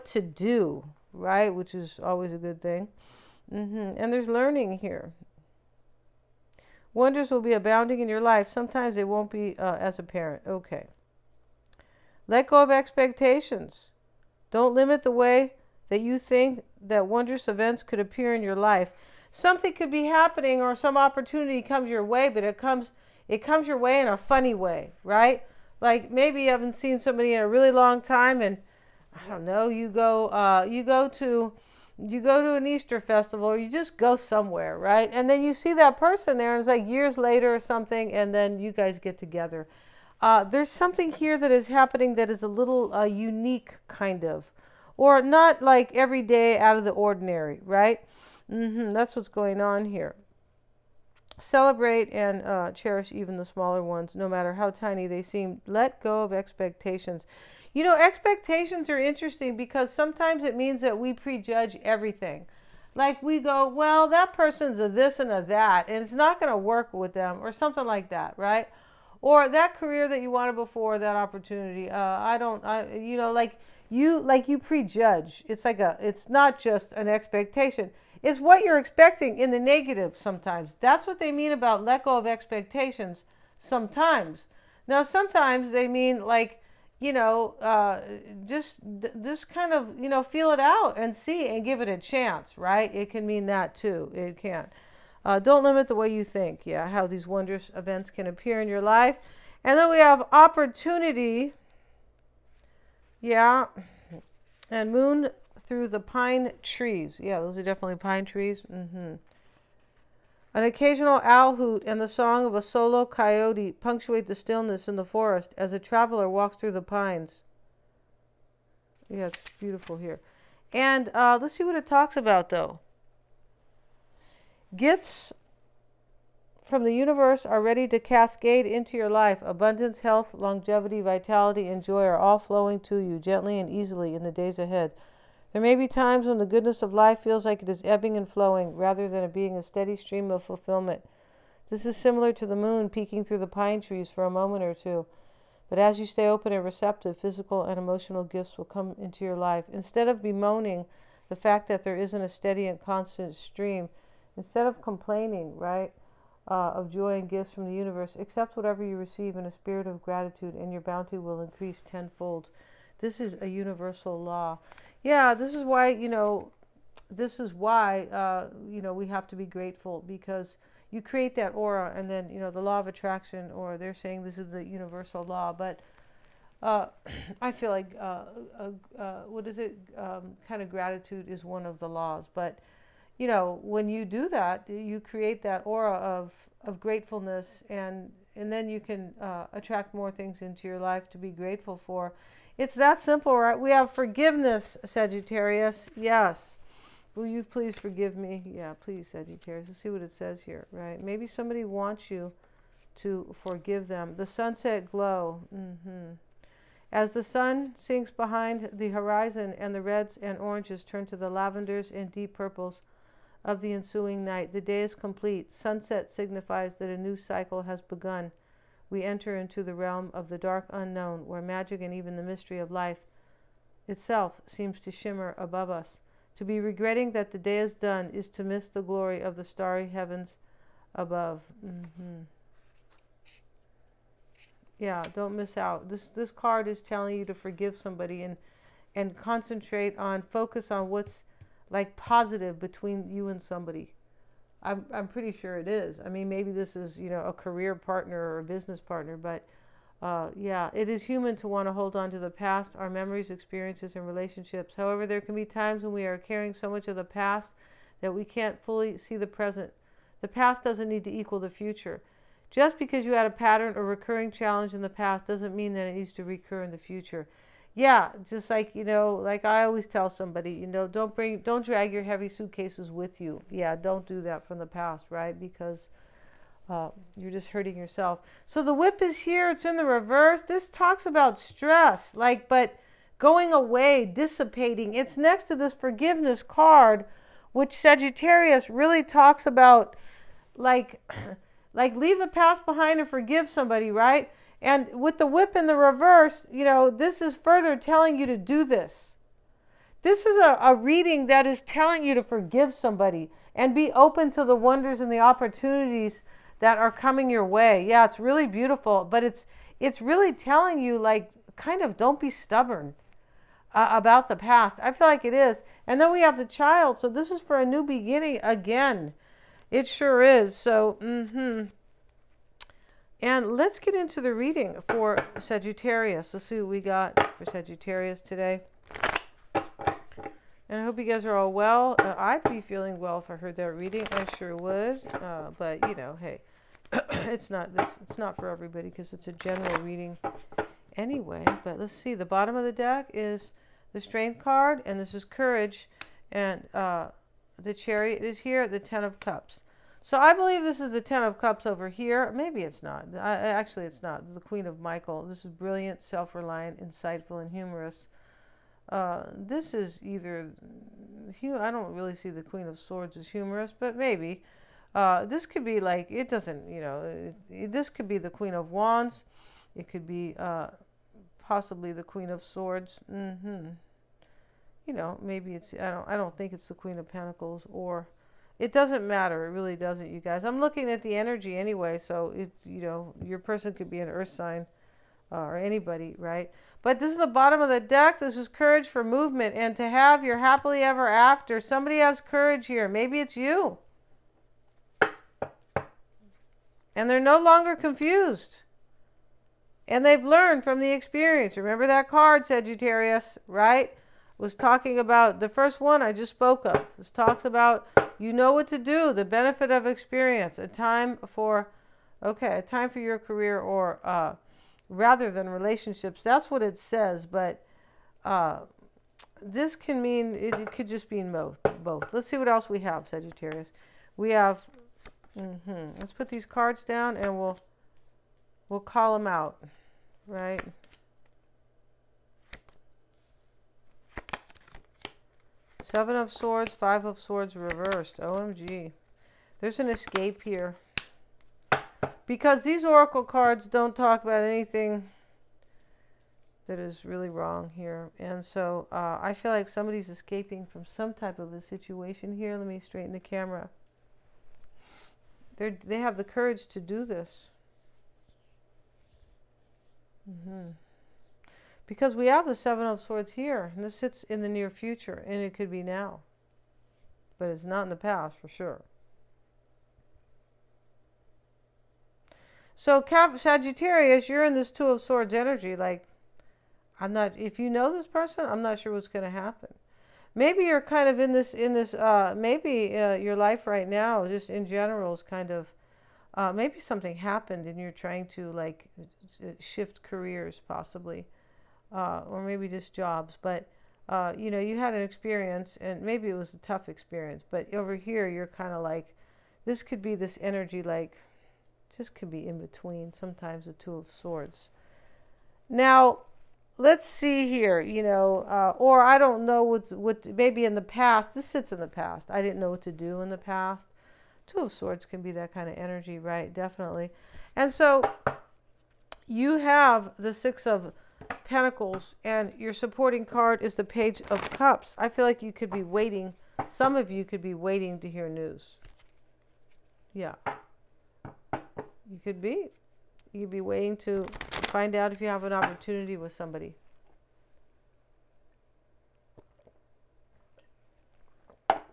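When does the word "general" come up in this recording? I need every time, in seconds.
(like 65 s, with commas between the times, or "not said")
339 s, 484 s.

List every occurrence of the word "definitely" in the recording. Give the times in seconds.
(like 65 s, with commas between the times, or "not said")
107 s, 516 s.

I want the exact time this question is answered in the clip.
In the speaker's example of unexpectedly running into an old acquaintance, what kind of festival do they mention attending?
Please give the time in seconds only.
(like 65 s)
32 s.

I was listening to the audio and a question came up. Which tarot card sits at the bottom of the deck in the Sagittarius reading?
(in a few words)
Strength.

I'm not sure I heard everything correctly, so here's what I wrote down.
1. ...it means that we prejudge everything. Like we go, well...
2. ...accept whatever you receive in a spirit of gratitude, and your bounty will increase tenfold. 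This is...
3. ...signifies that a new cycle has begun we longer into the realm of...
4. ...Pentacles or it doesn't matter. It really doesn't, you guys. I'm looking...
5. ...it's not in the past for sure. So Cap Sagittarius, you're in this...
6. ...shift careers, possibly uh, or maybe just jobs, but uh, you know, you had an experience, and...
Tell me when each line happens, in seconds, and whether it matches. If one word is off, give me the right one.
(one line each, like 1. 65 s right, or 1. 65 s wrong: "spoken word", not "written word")
1. 60 s right
2. 158 s right
3. 216 s wrong: "enter", not "longer"
4. 377 s right
5. 467 s right
6. 489 s right.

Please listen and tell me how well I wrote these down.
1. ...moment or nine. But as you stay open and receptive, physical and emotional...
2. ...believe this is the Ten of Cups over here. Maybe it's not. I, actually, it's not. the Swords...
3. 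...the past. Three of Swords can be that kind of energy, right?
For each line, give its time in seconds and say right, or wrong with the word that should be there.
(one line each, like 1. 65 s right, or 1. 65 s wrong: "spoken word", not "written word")
1. 144 s wrong: "two", not "nine"
2. 350 s wrong: "Queen", not "Swords"
3. 513 s wrong: "Two", not "Three".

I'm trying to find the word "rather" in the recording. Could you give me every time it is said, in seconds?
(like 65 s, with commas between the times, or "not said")
138 s, 414 s.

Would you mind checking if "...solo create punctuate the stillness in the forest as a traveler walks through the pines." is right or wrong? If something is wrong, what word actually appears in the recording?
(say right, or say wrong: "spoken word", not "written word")
wrong: "coyote", not "create".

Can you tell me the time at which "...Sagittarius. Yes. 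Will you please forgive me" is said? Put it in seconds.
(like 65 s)
194 s.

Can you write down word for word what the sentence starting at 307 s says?
Yeah, it's really beautiful, but it's it's really telling you like kind of don't be stubborn uh, about the past.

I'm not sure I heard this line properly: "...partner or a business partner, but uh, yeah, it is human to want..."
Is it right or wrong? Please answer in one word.
right.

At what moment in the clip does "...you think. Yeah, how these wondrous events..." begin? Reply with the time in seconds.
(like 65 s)
96 s.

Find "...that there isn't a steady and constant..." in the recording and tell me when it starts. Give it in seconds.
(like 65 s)
151 s.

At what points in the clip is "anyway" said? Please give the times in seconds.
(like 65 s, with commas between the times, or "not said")
340 s, 381 s.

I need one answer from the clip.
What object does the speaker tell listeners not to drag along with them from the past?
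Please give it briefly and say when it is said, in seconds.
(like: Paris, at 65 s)
heavy suitcases, at 272 s.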